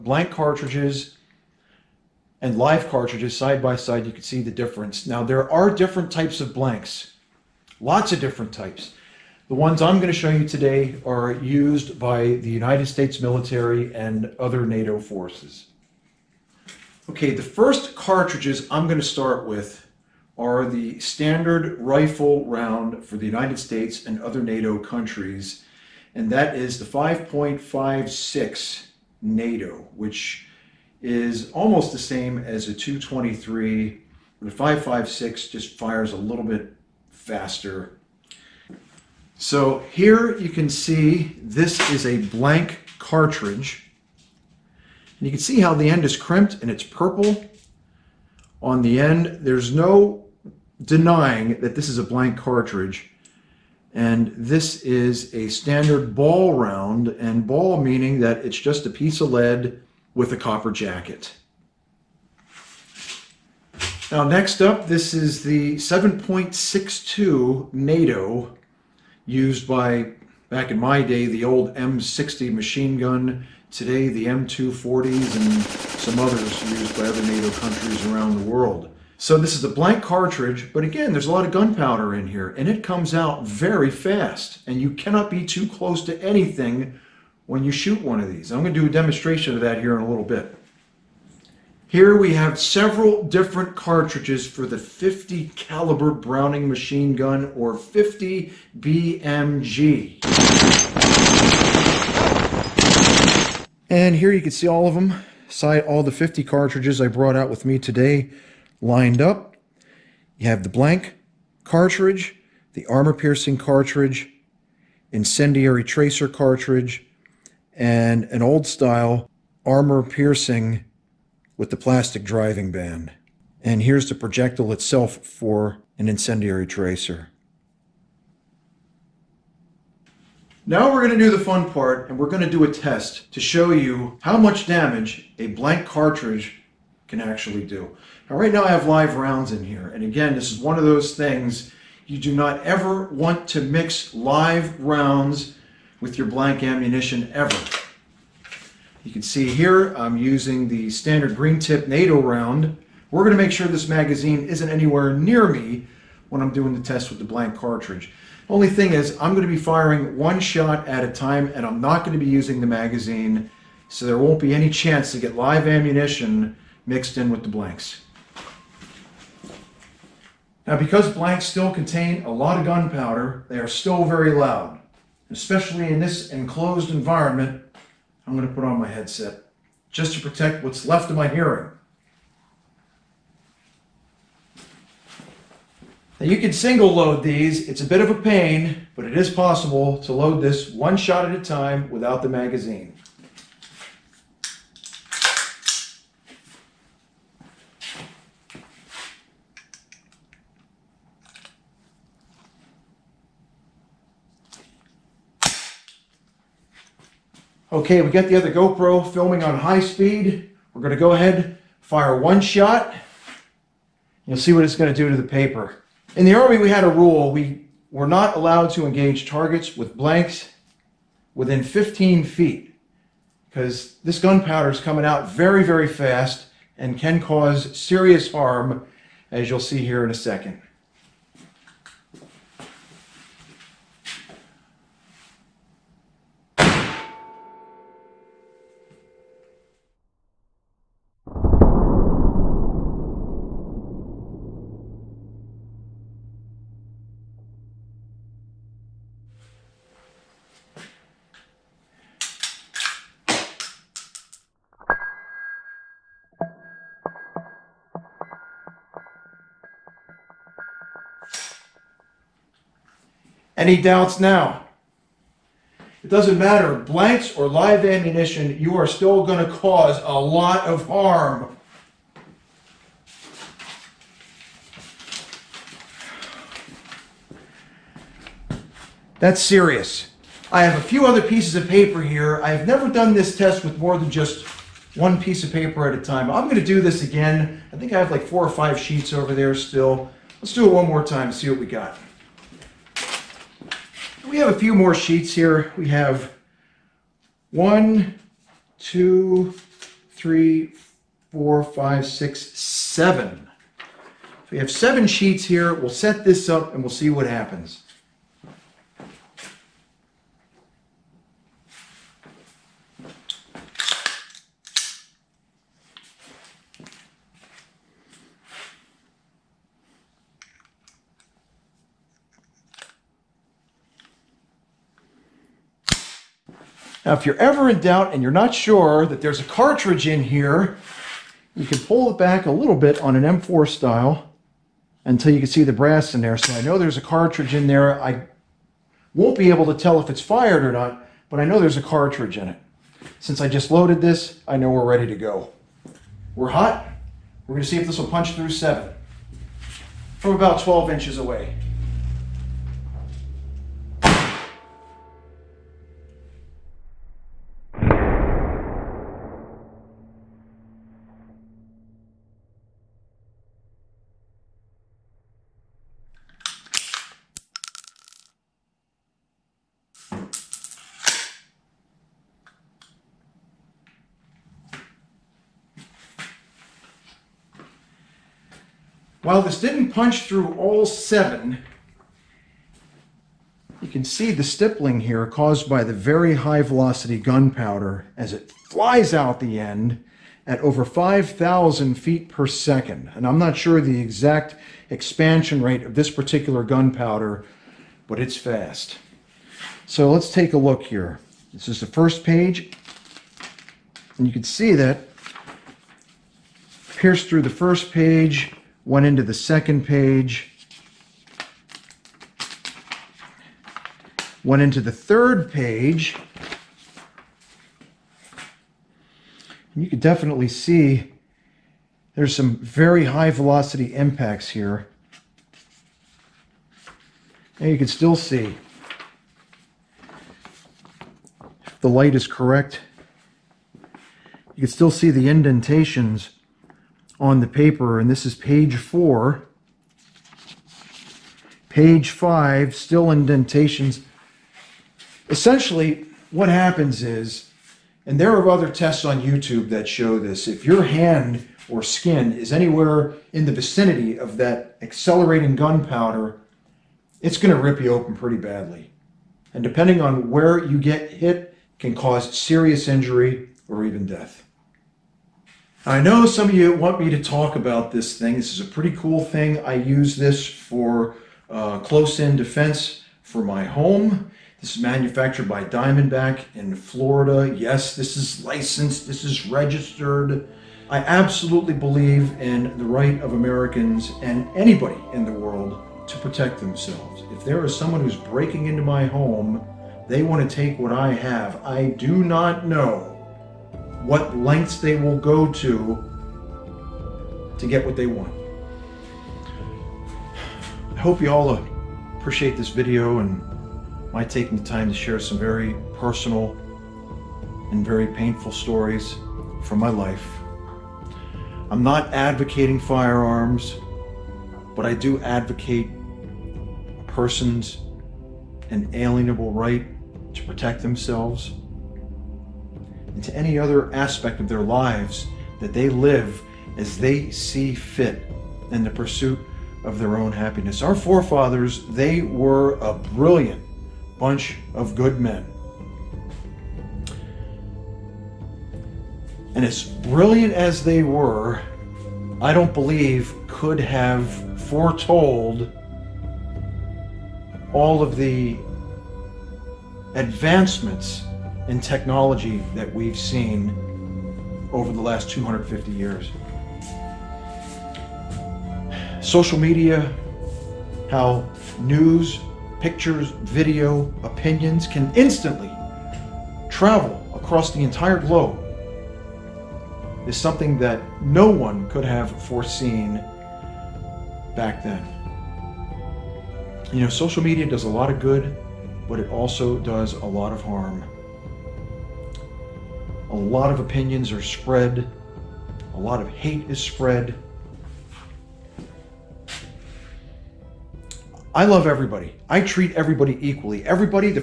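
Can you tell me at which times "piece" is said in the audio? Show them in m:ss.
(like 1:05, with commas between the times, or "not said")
0:58, 4:41, 4:45.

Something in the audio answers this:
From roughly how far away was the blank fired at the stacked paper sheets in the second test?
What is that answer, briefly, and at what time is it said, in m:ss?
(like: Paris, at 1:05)
12 inches, at 5:50.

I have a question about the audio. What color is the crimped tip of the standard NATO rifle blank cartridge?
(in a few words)
Purple.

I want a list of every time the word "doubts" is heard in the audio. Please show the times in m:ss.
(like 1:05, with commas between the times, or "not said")
4:23, 5:27.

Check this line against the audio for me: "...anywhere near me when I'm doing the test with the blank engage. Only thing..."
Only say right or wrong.
wrong.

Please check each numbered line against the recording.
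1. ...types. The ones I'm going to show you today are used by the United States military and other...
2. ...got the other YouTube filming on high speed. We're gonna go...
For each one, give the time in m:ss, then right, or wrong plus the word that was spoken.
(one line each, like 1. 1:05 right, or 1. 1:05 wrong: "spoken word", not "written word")
1. 0:08 right
2. 3:28 wrong: "GoPro", not "YouTube".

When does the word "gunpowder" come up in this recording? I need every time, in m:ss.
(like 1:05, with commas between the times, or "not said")
1:21, 2:52, 3:44, 6:27, 6:36, 7:35.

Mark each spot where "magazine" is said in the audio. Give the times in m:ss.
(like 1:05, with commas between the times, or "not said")
2:33, 2:42, 3:12.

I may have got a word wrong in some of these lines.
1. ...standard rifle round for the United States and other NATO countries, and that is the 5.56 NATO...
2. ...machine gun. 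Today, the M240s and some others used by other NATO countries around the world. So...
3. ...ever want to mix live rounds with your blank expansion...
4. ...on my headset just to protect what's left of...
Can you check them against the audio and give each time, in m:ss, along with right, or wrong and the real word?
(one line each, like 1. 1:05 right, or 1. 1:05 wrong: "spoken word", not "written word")
1. 0:21 right
2. 1:12 right
3. 2:22 wrong: "ammunition", not "expansion"
4. 2:58 right.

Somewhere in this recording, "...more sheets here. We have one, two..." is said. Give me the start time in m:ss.
4:54.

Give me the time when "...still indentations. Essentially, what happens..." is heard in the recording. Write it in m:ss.
7:22.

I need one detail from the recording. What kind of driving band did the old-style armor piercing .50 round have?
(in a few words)
Plastic.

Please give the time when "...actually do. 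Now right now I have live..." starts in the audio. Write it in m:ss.
2:17.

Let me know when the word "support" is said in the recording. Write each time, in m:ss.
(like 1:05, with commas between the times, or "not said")
not said.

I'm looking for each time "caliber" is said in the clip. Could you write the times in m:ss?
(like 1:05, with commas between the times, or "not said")
1:35.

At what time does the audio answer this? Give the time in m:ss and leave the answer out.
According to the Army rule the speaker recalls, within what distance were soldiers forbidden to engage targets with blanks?
3:41.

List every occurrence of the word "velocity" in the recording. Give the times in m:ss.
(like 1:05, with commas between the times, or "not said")
6:26, 7:03.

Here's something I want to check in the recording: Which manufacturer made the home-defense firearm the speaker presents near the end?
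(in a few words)
Diamondback.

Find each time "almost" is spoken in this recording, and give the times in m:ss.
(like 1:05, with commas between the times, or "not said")
0:31.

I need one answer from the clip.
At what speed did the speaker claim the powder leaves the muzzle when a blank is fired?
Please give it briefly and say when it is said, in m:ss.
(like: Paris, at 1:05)
Over 5,000 feet per second, at 6:30.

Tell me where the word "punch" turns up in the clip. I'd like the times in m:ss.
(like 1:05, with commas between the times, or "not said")
5:48, 6:19.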